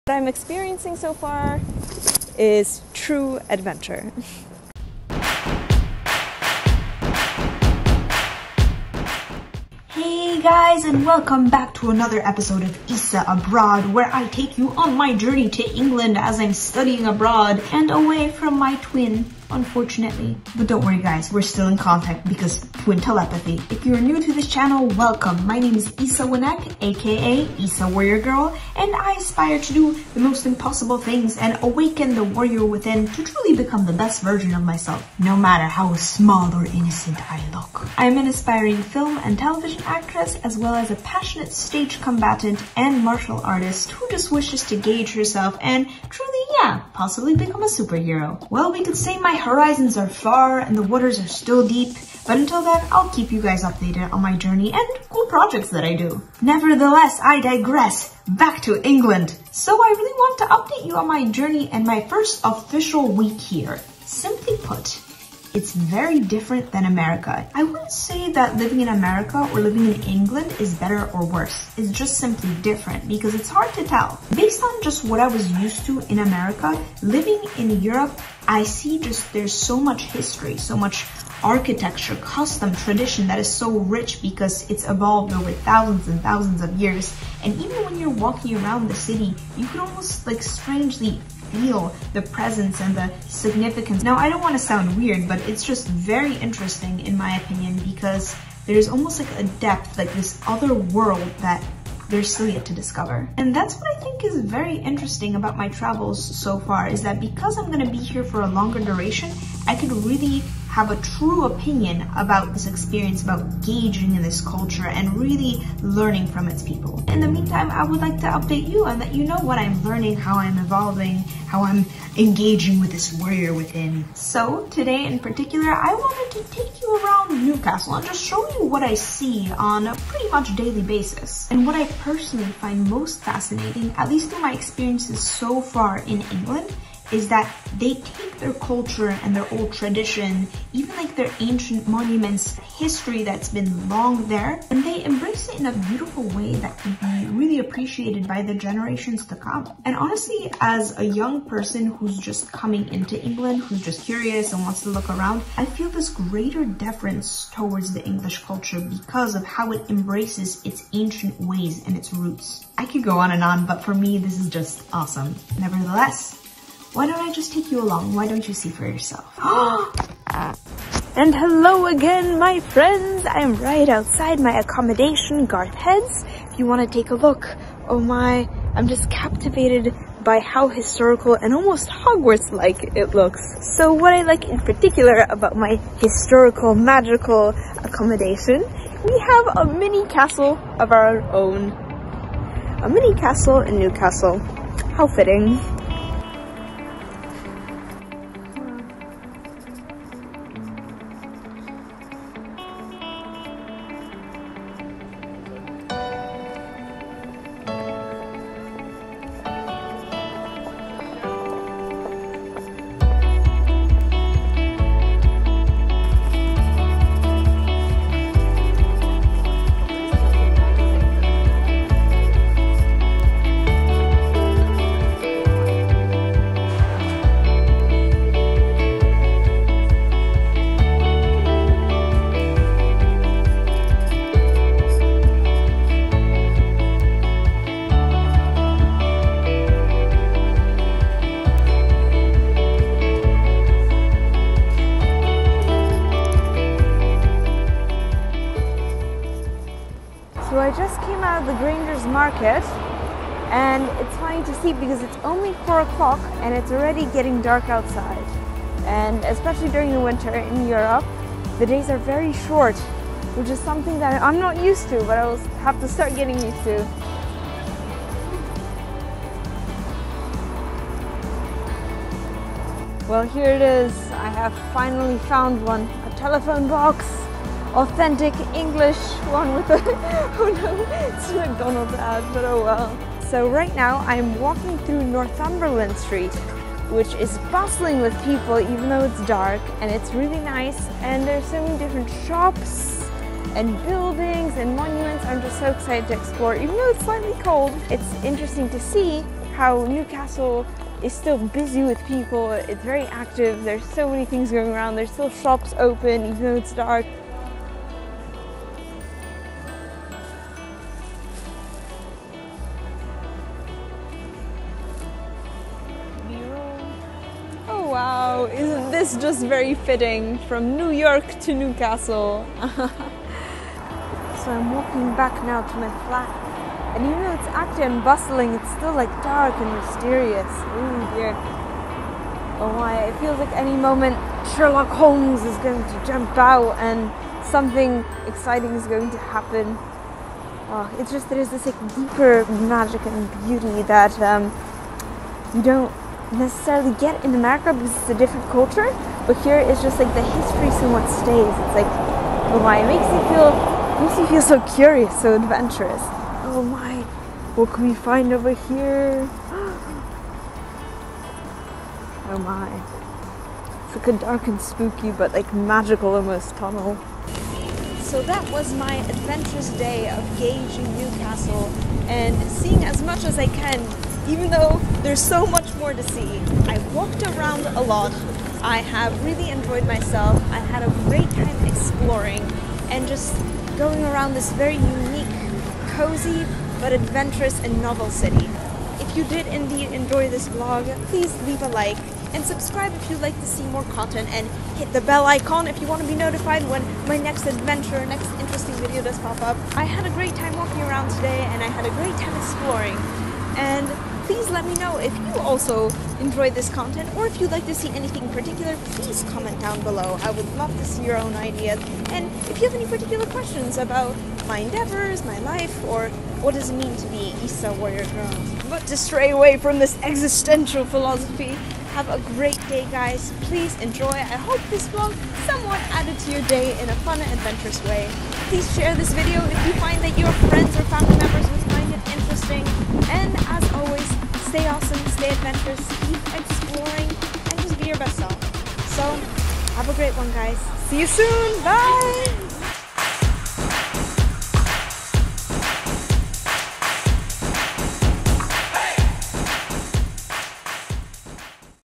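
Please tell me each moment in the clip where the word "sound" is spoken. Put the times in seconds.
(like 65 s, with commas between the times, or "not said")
94 s.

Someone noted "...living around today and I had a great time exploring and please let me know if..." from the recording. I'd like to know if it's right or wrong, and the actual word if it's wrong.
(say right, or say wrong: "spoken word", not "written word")
wrong: "walking", not "living".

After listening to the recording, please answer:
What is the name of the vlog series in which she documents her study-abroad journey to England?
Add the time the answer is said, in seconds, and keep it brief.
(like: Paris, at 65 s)
Isa Abroad, at 12 s.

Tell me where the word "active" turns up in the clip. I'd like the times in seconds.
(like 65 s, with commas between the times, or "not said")
303 s, 327 s.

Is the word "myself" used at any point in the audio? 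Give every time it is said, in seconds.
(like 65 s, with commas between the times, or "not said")
34 s, 379 s.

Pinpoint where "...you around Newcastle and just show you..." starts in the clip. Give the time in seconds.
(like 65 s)
126 s.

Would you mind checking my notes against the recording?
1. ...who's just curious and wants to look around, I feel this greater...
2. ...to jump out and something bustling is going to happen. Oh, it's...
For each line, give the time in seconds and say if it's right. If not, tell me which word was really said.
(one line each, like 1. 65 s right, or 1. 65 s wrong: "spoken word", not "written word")
1. 153 s right
2. 335 s wrong: "exciting", not "bustling".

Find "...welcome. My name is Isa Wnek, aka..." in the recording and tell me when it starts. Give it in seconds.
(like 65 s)
24 s.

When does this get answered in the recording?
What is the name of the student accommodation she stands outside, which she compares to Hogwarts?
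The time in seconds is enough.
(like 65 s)
175 s.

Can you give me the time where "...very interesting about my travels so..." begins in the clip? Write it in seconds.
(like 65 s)
104 s.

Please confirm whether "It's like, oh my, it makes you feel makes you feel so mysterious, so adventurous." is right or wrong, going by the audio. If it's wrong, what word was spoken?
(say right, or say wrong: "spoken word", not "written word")
wrong: "curious", not "mysterious".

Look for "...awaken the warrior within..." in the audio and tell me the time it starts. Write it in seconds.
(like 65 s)
31 s.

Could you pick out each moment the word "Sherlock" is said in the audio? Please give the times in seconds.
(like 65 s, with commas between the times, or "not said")
334 s.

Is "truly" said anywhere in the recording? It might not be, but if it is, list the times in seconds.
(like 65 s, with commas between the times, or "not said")
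33 s, 46 s.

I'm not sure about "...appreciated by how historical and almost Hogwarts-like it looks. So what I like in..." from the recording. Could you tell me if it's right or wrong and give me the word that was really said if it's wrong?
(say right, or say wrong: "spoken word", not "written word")
wrong: "captivated", not "appreciated".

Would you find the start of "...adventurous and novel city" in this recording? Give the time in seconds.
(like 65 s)
386 s.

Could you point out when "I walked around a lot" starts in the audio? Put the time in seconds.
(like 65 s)
376 s.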